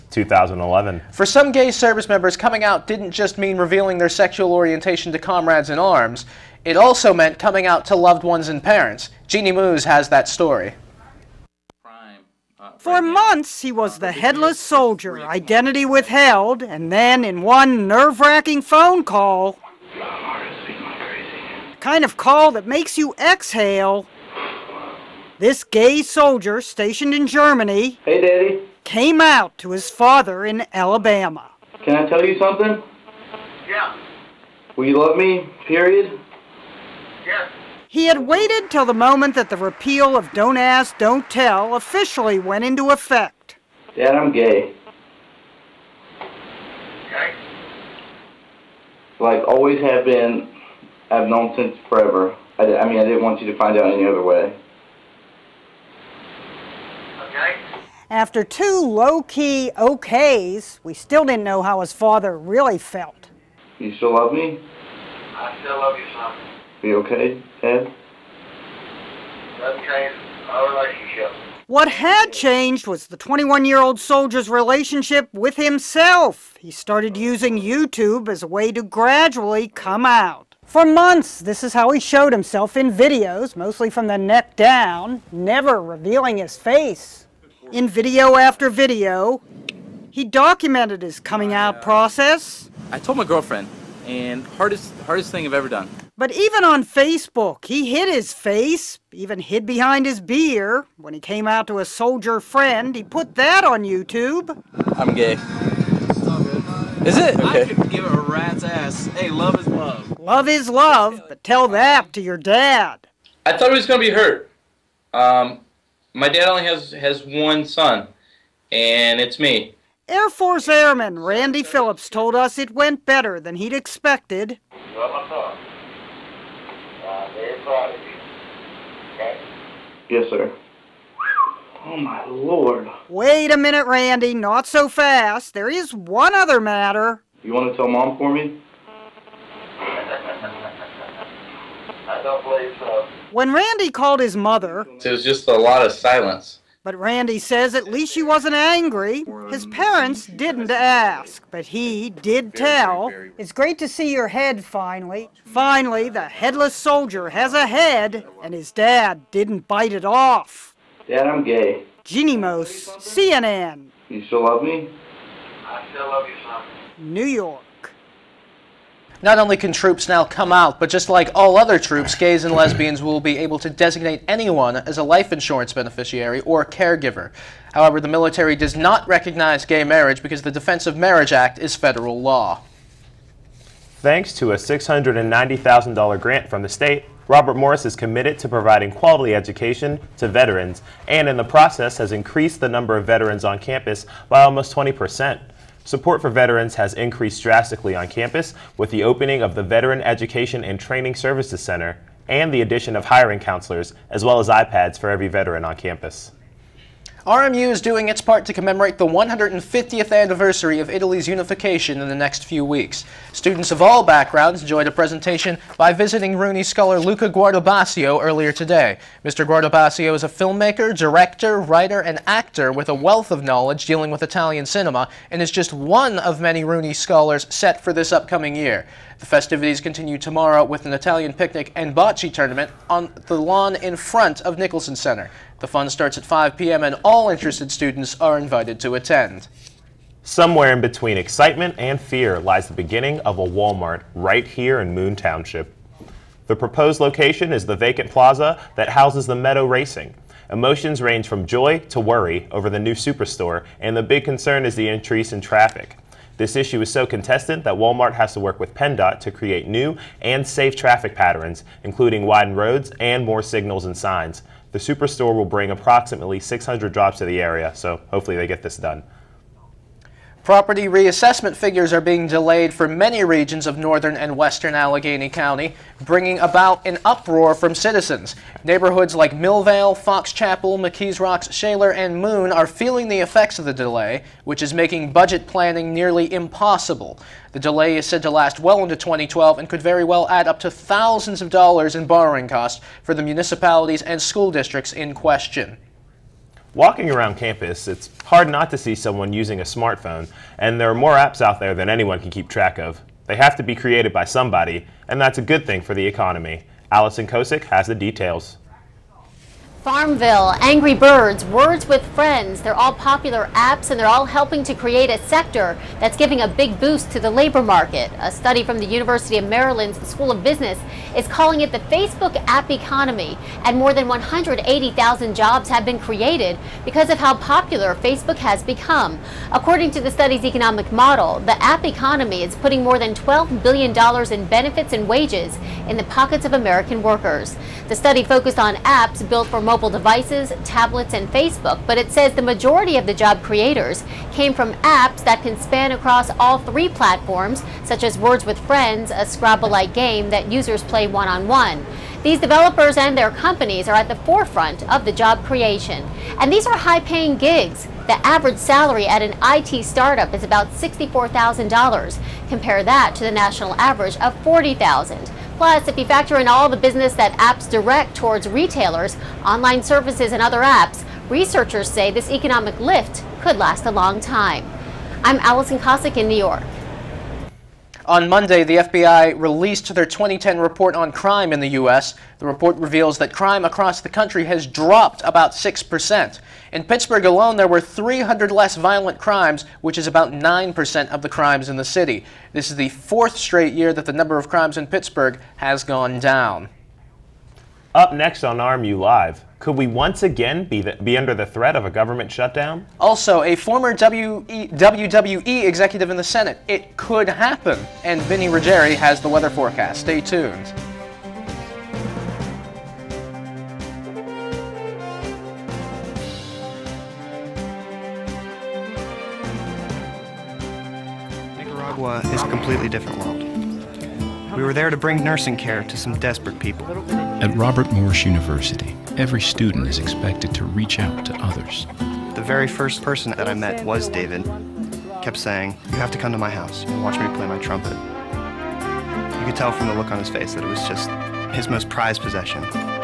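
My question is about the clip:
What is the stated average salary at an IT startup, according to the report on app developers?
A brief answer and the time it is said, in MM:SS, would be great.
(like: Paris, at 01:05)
$64,000, at 06:00.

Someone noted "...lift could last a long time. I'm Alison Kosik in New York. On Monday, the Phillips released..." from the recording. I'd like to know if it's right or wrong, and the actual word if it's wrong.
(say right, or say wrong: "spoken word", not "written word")
wrong: "FBI", not "Phillips".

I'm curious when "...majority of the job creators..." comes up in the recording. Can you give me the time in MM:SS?
05:42.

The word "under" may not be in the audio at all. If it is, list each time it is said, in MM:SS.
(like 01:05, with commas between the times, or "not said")
06:41.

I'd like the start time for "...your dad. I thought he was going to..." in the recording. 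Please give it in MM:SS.
01:52.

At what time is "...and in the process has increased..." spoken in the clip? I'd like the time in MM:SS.
03:11.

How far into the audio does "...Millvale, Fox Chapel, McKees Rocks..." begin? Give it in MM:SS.
04:39.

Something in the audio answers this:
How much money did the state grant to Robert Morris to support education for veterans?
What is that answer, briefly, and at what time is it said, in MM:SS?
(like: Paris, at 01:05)
$690,000, at 03:04.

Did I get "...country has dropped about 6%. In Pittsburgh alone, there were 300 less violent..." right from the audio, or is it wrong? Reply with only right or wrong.
right.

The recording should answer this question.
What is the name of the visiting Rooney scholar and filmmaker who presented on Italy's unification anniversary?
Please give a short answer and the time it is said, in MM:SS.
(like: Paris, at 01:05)
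Luca Guardabasio, at 03:36.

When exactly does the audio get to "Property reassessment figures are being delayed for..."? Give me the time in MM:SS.
04:30.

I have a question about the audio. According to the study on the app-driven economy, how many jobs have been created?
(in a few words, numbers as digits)
180,000.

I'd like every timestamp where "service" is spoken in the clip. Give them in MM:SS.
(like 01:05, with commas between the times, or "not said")
00:01, 03:21, 06:09.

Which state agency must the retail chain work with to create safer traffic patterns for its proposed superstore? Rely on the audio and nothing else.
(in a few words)
PennDOT.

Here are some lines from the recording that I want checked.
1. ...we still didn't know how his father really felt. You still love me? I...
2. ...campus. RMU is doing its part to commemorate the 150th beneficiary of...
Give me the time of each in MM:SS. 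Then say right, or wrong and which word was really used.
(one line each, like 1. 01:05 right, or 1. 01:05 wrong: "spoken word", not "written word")
1. 01:00 right
2. 03:25 wrong: "anniversary", not "beneficiary".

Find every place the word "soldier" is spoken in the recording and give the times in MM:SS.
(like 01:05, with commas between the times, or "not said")
00:14, 00:26, 01:13, 01:41, 02:36.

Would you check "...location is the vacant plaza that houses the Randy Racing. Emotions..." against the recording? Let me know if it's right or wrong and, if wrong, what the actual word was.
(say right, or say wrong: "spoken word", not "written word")
wrong: "Meadow", not "Randy".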